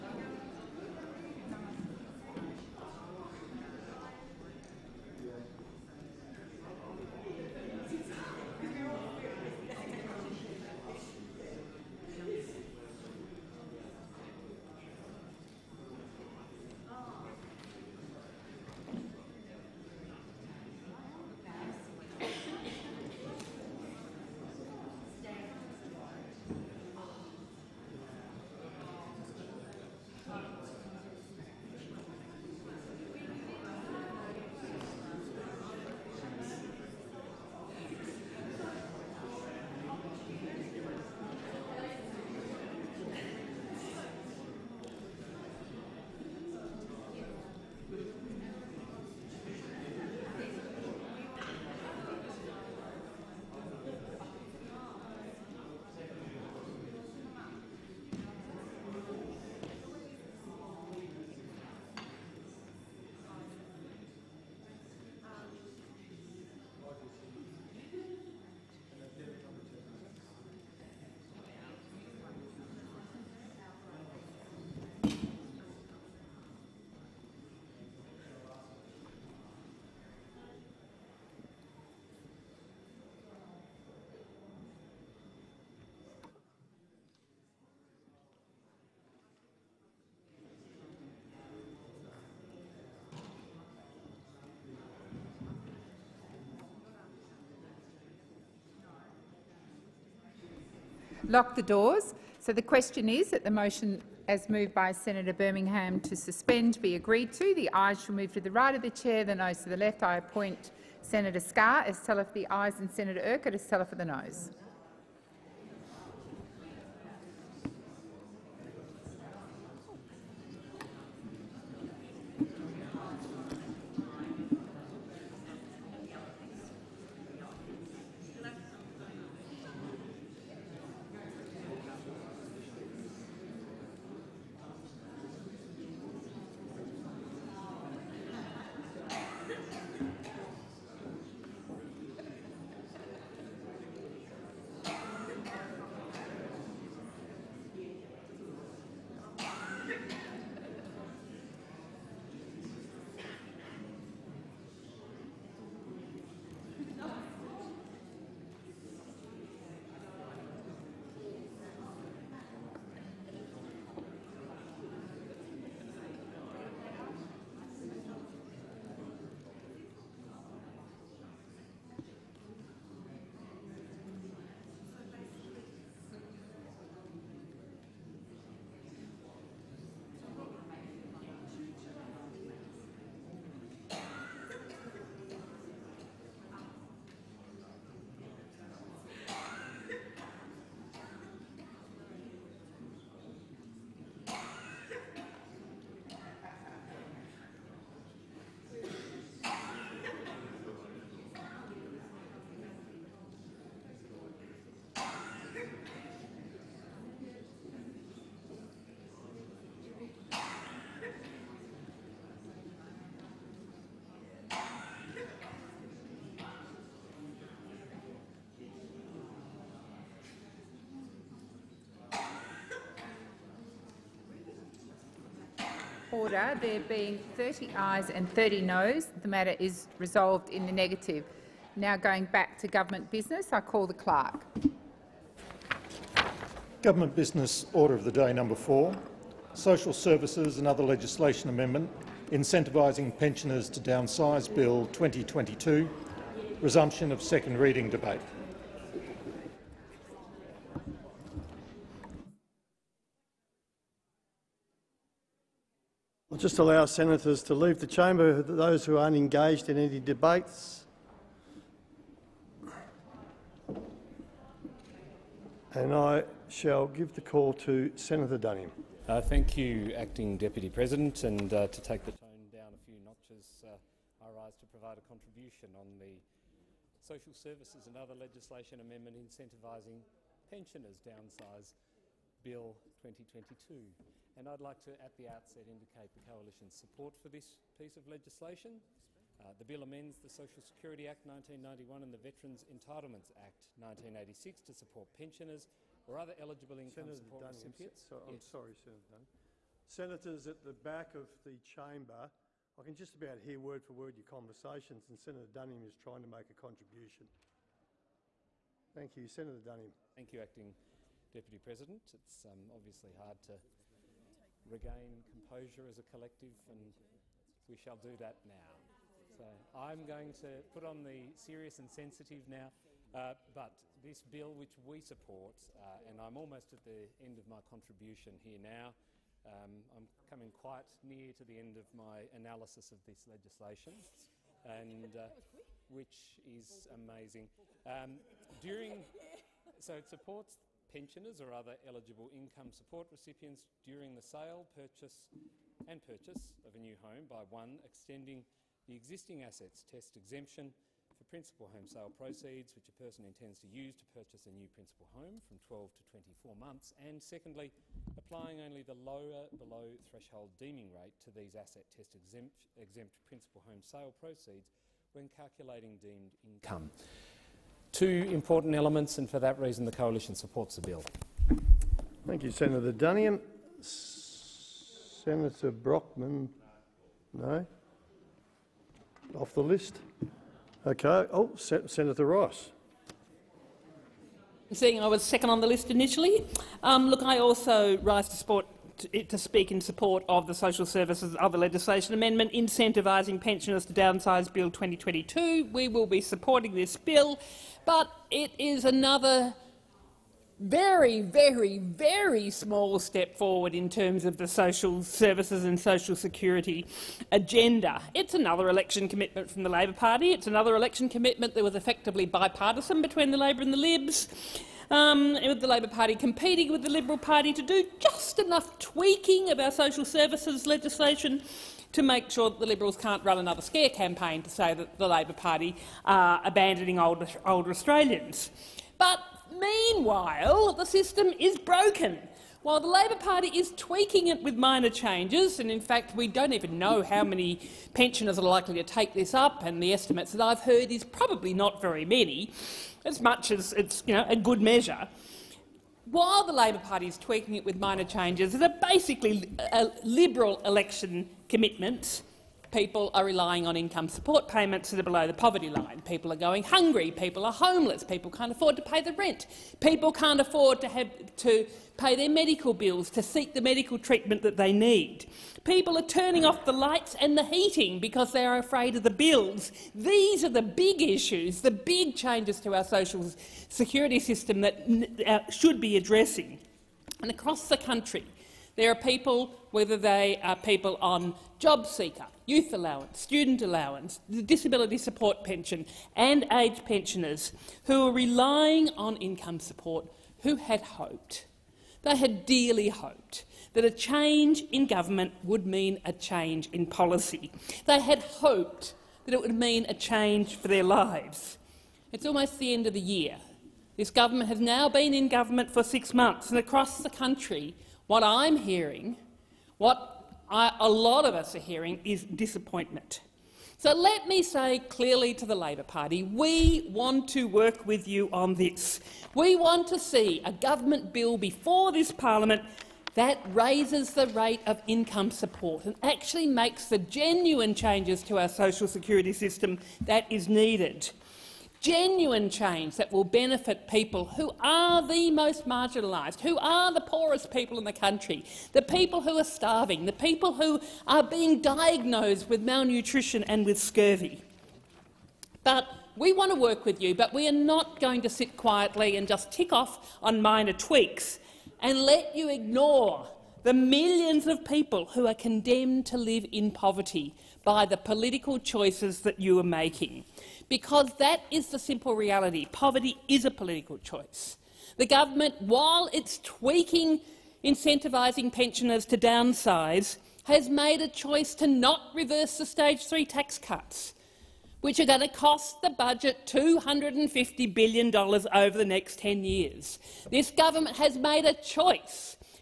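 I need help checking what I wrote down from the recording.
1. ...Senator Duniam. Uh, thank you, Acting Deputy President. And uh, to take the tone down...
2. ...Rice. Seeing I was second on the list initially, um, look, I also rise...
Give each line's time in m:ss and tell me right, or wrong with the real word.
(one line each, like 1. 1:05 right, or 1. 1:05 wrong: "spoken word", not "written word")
1. 4:27 right
2. 6:22 right.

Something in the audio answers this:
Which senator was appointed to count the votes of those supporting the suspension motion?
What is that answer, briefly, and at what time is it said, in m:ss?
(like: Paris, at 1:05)
Senator Scarr, at 1:51.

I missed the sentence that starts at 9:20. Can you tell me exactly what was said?
Because that is the simple reality.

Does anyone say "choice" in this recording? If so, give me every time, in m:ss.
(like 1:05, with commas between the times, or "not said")
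9:18, 9:23, 9:31, 9:41.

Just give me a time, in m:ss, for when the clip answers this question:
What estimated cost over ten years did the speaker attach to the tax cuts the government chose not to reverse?
9:36.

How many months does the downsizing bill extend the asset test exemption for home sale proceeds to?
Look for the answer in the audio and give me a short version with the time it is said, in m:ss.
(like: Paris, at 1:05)
24 months, at 5:56.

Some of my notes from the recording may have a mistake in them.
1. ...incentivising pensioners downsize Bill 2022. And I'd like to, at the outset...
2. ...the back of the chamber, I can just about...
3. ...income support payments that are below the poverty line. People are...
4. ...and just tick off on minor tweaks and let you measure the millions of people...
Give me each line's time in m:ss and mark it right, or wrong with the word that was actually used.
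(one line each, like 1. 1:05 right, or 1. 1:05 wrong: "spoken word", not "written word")
1. 4:39 right
2. 5:00 right
3. 7:33 right
4. 9:09 wrong: "ignore", not "measure".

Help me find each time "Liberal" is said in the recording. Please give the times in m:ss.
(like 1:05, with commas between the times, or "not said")
6:56, 7:02, 7:30.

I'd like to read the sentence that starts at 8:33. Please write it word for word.
So let me say clearly to the Labor Party, we want to work with you on this.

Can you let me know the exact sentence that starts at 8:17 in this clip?
They had hoped that it would mean a change for their lives.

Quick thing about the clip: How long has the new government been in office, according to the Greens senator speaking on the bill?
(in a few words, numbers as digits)
6 months.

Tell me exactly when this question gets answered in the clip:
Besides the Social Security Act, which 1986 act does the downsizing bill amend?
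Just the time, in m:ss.
4:52.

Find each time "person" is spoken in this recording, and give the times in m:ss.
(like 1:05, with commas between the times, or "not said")
5:52.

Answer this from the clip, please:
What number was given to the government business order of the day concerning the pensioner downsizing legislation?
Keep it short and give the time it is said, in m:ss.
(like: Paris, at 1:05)
4, at 3:58.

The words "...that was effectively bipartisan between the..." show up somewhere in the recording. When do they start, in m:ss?
6:51.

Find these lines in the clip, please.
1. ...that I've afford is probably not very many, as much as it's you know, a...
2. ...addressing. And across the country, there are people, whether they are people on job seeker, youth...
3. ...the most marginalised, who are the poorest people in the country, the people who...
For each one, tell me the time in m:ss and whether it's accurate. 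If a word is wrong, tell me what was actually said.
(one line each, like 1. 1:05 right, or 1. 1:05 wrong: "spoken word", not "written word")
1. 7:20 wrong: "heard", not "afford"
2. 7:55 right
3. 8:55 right.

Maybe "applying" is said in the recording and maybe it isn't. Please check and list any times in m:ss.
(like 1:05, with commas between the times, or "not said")
5:58.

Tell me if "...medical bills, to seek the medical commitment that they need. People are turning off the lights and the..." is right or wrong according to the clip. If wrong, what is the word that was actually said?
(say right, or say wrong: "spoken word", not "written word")
wrong: "treatment", not "commitment".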